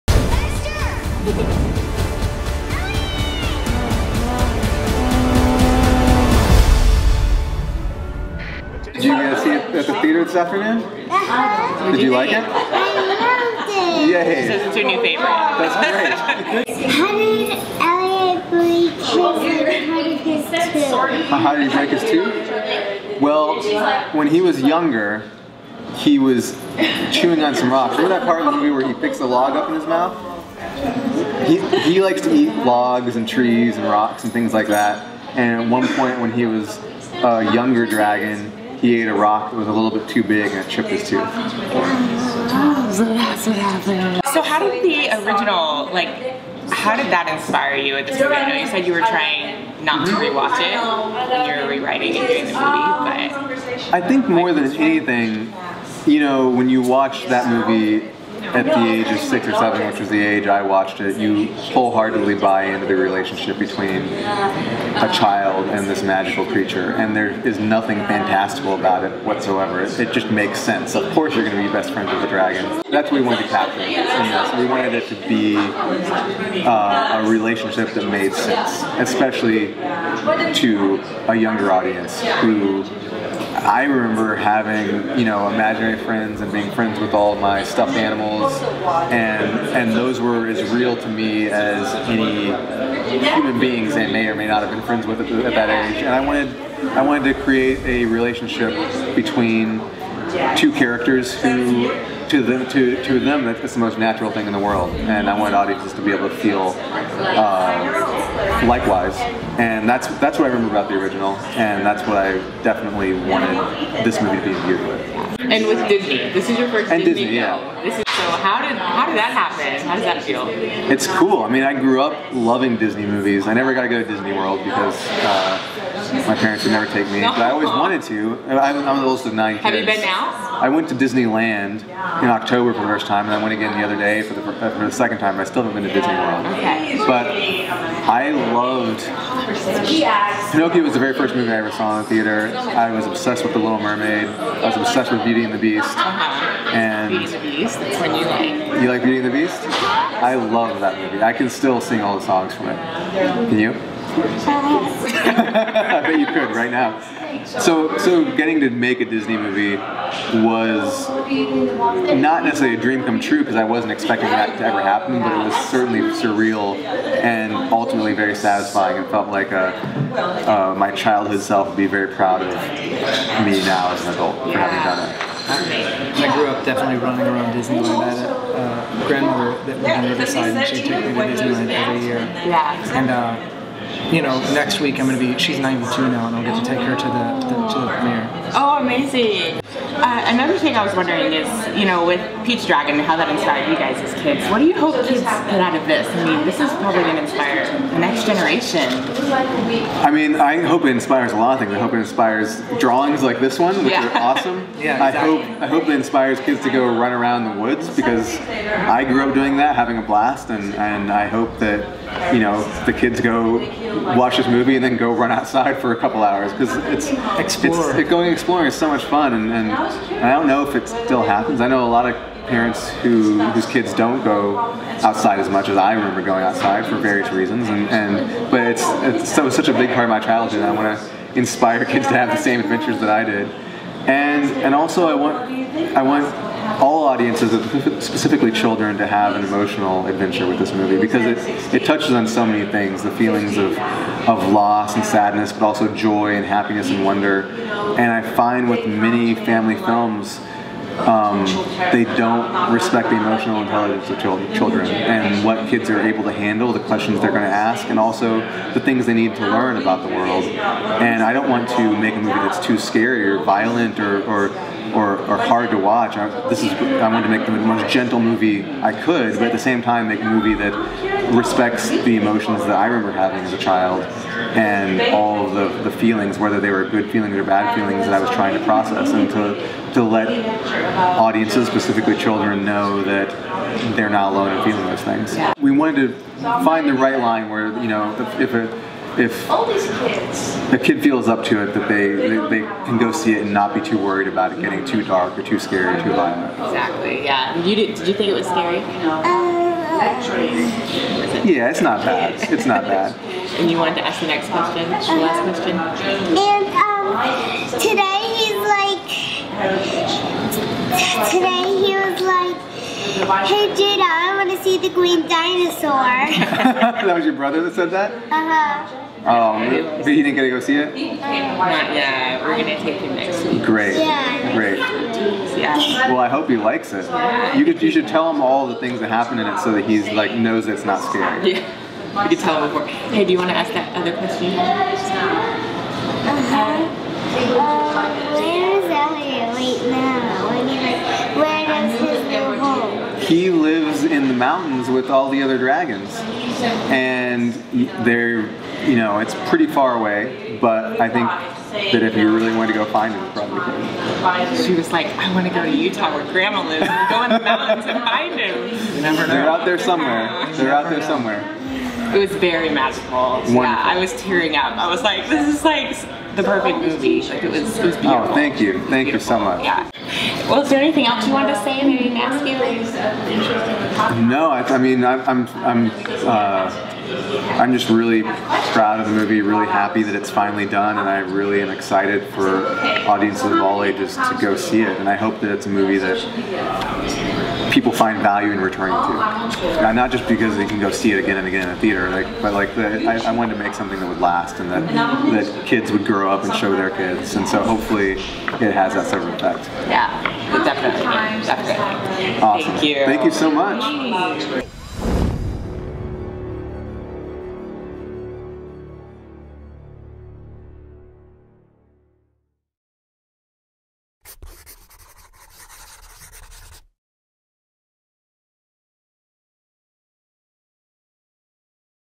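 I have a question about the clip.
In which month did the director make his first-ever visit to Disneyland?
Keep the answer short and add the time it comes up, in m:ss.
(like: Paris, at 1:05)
October, at 2:12.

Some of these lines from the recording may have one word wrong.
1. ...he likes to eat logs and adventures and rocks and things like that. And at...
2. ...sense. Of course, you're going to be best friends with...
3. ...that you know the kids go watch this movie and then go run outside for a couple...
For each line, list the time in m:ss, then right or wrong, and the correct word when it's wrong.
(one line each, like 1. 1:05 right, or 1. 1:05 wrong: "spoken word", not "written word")
1. 0:31 wrong: "trees", not "adventures"
2. 1:10 right
3. 3:31 right.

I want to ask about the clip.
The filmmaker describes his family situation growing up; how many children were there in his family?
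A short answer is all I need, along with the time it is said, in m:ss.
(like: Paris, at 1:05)
9, at 2:09.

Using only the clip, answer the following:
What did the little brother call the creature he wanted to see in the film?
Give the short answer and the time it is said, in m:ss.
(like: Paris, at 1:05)
The green dinosaur, at 5:14.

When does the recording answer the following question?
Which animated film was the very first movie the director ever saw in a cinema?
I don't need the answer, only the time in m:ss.
2:20.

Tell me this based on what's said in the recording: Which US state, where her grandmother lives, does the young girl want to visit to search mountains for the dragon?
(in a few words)
Utah.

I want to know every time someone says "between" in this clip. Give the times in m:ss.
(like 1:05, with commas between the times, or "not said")
1:03, 1:39.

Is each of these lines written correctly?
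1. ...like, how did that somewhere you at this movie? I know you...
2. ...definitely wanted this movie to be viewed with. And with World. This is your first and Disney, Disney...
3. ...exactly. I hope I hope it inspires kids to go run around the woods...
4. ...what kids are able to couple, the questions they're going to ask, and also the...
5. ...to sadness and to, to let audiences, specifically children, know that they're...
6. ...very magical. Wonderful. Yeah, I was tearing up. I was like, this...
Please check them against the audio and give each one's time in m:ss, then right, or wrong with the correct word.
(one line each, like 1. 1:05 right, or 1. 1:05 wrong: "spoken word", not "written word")
1. 0:45 wrong: "inspire", not "somewhere"
2. 1:52 wrong: "Disney", not "World"
3. 3:24 right
4. 4:15 wrong: "handle", not "couple"
5. 4:38 wrong: "process", not "sadness"
6. 6:02 right.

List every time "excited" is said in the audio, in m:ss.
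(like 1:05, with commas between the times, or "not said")
6:21.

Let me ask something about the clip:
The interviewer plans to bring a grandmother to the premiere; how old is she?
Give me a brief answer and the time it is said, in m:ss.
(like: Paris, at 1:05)
92, at 3:05.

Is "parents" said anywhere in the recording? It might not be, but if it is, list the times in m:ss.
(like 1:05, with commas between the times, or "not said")
2:06, 3:42.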